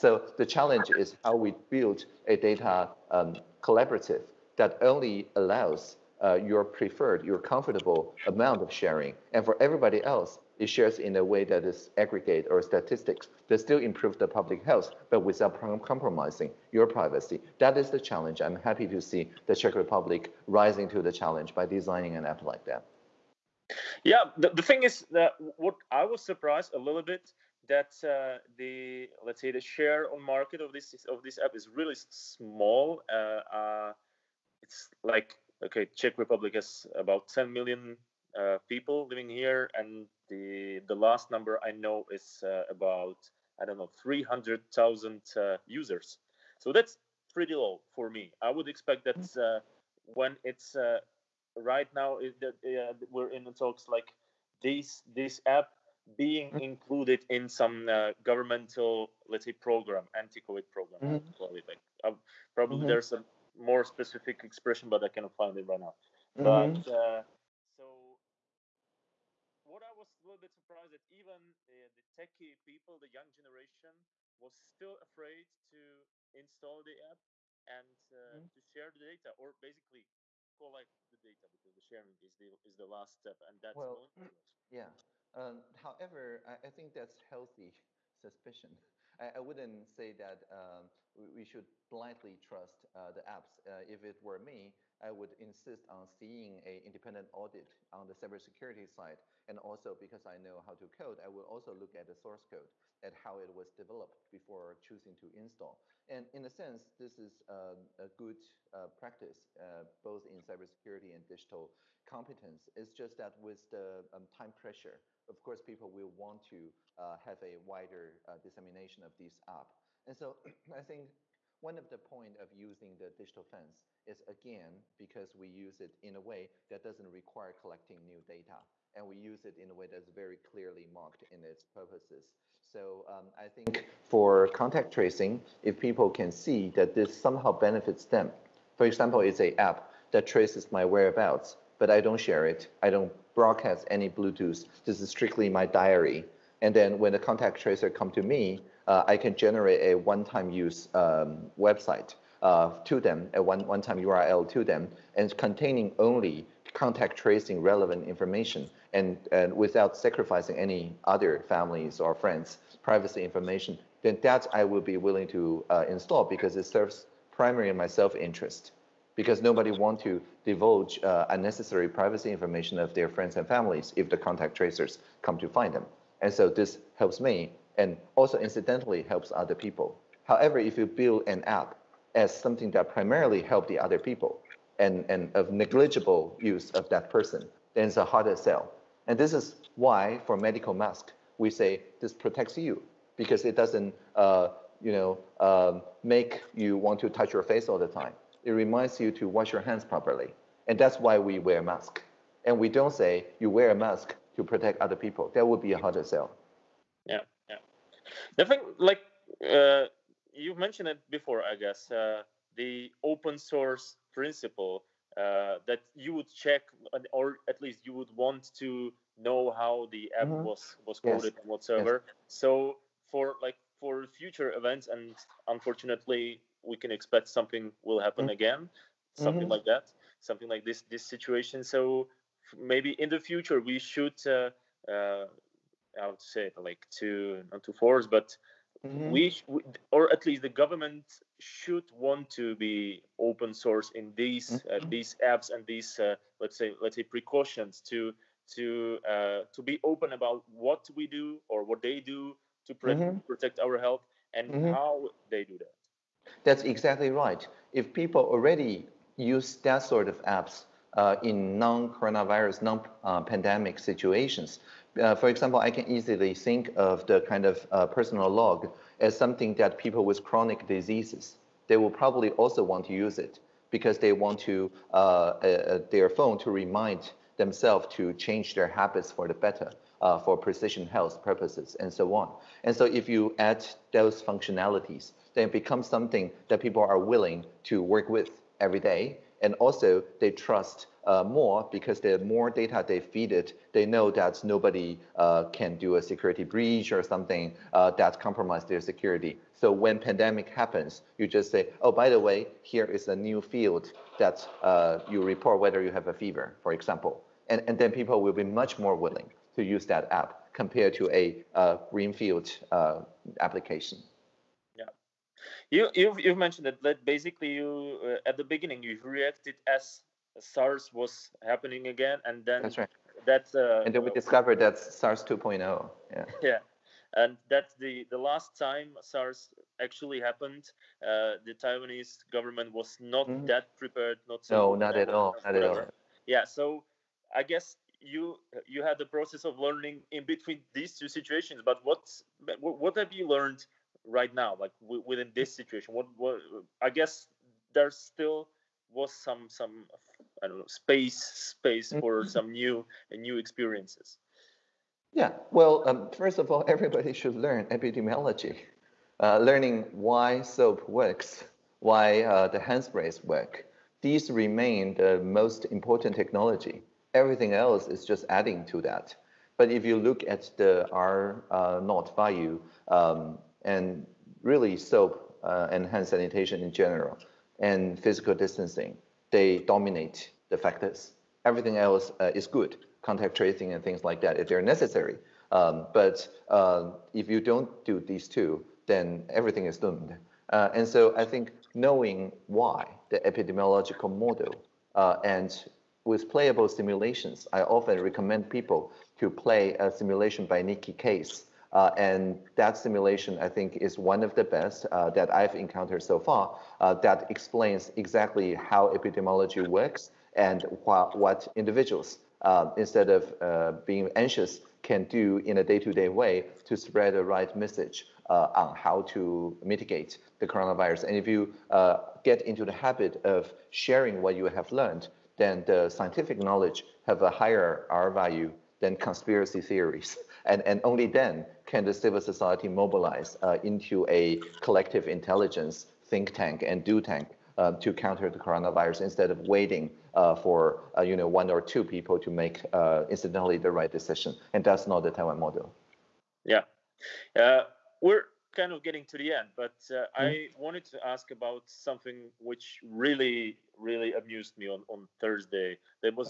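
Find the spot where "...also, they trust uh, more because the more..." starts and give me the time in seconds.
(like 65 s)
289 s.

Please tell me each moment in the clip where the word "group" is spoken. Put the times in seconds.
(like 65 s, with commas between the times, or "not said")
not said.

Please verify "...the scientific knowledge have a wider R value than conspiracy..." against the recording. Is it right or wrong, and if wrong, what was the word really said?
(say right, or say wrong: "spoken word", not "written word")
wrong: "higher", not "wider".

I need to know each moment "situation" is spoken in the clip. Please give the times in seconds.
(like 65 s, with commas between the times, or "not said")
231 s, 263 s, 341 s, 345 s.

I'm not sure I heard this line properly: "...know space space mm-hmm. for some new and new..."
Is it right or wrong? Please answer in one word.
right.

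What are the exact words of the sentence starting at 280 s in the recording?
Uh, for precision health purposes and so on.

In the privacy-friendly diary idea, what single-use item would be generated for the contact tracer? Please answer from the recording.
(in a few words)
one-time URL.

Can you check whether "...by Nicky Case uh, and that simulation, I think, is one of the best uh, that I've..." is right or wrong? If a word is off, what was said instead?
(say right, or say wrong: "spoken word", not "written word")
right.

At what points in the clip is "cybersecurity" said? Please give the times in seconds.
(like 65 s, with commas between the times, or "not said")
98 s, 110 s.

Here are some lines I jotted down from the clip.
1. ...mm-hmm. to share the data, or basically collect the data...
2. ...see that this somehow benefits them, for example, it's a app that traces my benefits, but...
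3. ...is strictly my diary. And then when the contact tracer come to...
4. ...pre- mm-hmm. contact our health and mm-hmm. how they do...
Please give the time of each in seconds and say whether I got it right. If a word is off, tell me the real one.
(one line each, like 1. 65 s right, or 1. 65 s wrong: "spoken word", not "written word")
1. 78 s right
2. 136 s wrong: "whereabouts", not "benefits"
3. 145 s right
4. 252 s wrong: "protect", not "contact".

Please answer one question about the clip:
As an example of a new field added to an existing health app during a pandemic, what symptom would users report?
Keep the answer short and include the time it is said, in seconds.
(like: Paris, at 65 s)
fever, at 306 s.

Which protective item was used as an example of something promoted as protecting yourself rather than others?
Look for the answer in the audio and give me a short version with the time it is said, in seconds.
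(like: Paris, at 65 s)
medical mask, at 190 s.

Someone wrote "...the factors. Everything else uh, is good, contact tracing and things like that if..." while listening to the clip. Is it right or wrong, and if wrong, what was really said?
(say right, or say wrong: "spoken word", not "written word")
right.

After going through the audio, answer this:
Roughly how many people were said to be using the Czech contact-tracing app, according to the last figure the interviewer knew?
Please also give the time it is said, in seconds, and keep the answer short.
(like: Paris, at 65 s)
300,000, at 44 s.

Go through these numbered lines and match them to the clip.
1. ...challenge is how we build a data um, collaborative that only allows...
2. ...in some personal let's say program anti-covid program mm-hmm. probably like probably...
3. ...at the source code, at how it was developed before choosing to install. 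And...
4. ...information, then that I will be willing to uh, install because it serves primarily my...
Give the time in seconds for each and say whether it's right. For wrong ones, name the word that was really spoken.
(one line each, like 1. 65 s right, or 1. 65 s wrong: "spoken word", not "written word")
1. 0 s right
2. 57 s wrong: "governmental", not "personal"
3. 101 s right
4. 163 s right.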